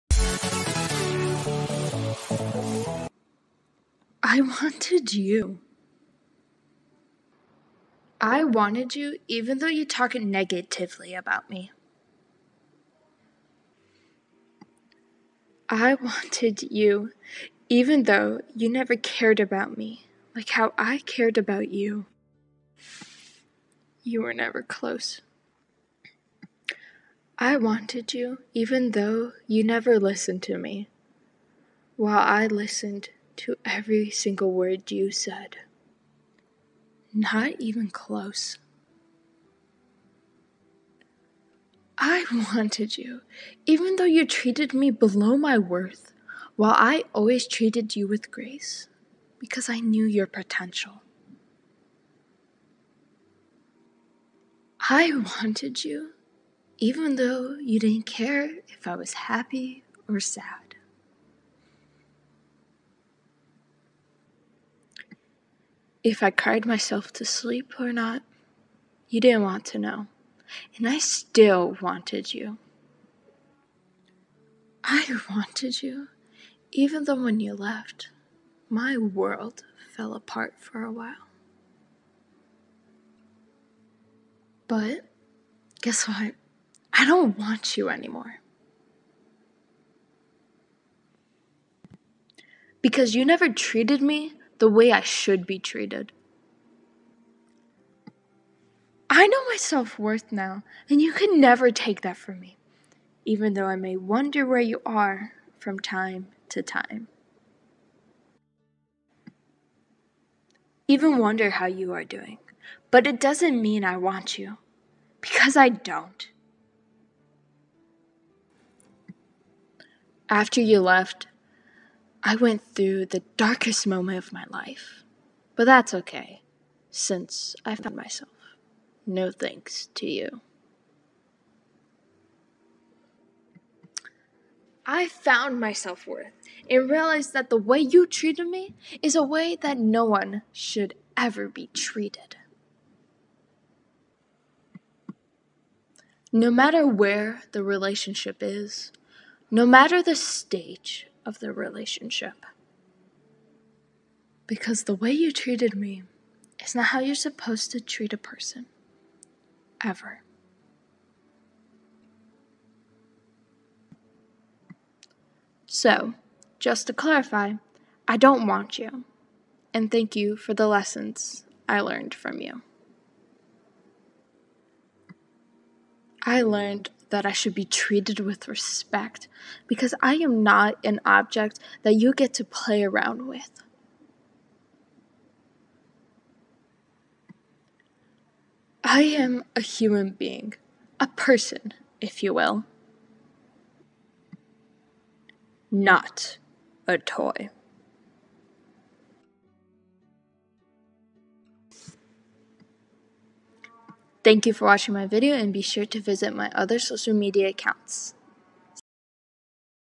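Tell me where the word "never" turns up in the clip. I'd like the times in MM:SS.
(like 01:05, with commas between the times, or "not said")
00:18, 00:24, 00:29, 01:33, 01:41.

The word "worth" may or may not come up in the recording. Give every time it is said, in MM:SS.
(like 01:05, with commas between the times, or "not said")
00:45, 01:39, 02:16.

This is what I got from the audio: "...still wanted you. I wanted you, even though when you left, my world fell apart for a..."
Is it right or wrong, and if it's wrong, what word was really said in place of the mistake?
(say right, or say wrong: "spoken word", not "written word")
right.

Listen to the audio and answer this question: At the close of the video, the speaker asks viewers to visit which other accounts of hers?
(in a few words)
Social media accounts.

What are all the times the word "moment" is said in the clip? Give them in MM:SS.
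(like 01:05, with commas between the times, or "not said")
02:03.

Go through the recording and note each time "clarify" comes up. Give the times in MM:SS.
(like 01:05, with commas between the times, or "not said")
02:46.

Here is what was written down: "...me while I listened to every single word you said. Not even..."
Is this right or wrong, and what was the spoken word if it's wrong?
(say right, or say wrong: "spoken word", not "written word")
right.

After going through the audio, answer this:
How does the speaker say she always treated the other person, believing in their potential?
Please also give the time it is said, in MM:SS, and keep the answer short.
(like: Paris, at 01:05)
With grace, at 00:48.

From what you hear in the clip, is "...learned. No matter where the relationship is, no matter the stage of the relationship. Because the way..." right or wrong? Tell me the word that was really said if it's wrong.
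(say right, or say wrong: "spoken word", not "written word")
wrong: "treated", not "learned".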